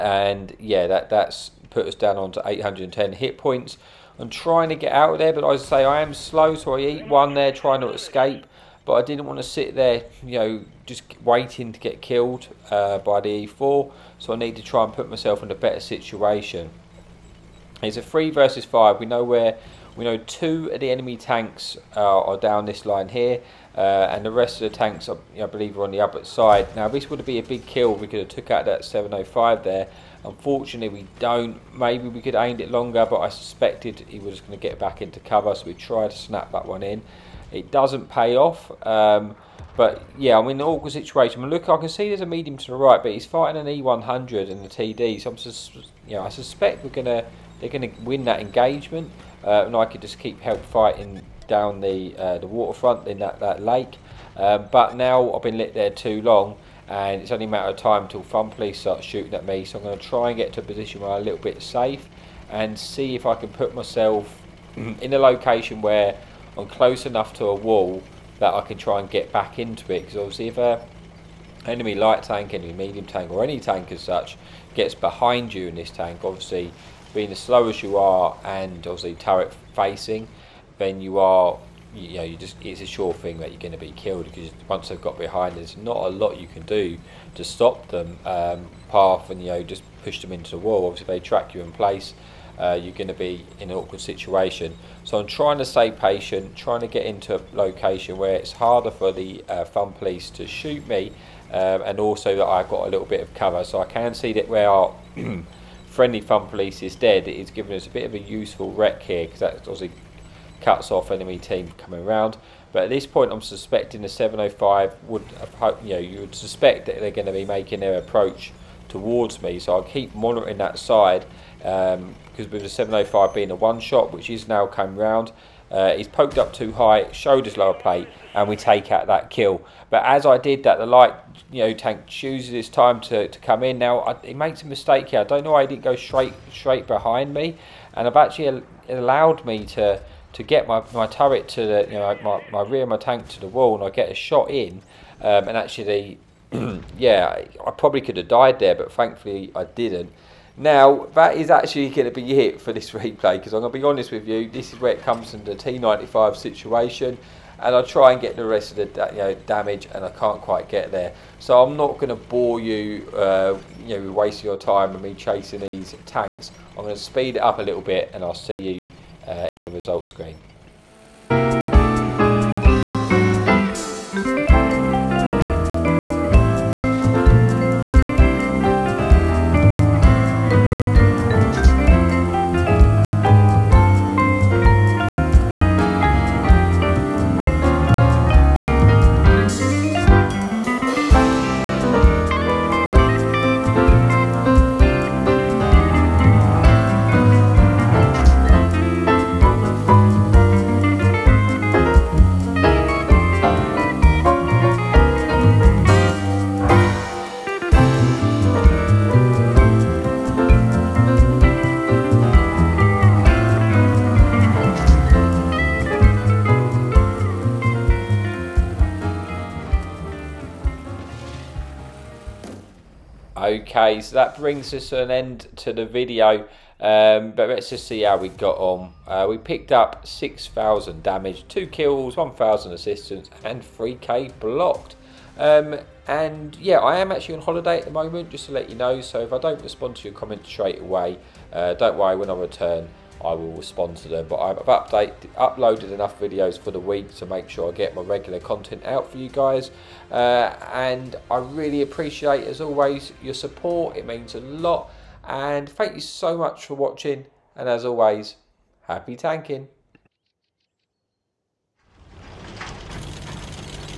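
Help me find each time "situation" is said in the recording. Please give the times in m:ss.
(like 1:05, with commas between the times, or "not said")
0:15, 0:40, 1:33, 2:36.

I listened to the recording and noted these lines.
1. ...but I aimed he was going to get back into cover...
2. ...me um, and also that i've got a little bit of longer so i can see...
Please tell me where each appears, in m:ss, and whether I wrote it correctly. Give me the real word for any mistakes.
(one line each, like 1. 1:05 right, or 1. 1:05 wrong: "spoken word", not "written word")
1. 0:33 wrong: "suspected", not "aimed"
2. 1:40 wrong: "cover", not "longer".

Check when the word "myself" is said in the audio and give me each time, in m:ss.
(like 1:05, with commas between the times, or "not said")
0:15, 1:03.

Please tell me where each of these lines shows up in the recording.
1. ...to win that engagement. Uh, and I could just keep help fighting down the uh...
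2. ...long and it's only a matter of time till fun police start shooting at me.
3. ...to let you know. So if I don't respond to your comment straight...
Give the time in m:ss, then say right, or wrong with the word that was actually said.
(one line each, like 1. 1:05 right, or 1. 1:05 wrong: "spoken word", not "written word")
1. 0:47 right
2. 0:56 right
3. 3:58 right.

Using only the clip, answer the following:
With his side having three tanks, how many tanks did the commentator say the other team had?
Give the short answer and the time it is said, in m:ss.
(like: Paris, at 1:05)
5, at 0:18.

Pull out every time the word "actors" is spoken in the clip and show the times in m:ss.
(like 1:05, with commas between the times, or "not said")
not said.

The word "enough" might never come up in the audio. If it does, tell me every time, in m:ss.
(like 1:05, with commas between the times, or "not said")
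1:07, 4:05.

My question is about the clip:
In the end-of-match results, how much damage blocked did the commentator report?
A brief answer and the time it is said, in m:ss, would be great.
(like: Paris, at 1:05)
3k, at 3:53.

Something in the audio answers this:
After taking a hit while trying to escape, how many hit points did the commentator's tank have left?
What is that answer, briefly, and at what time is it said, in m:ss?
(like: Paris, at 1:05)
810, at 0:02.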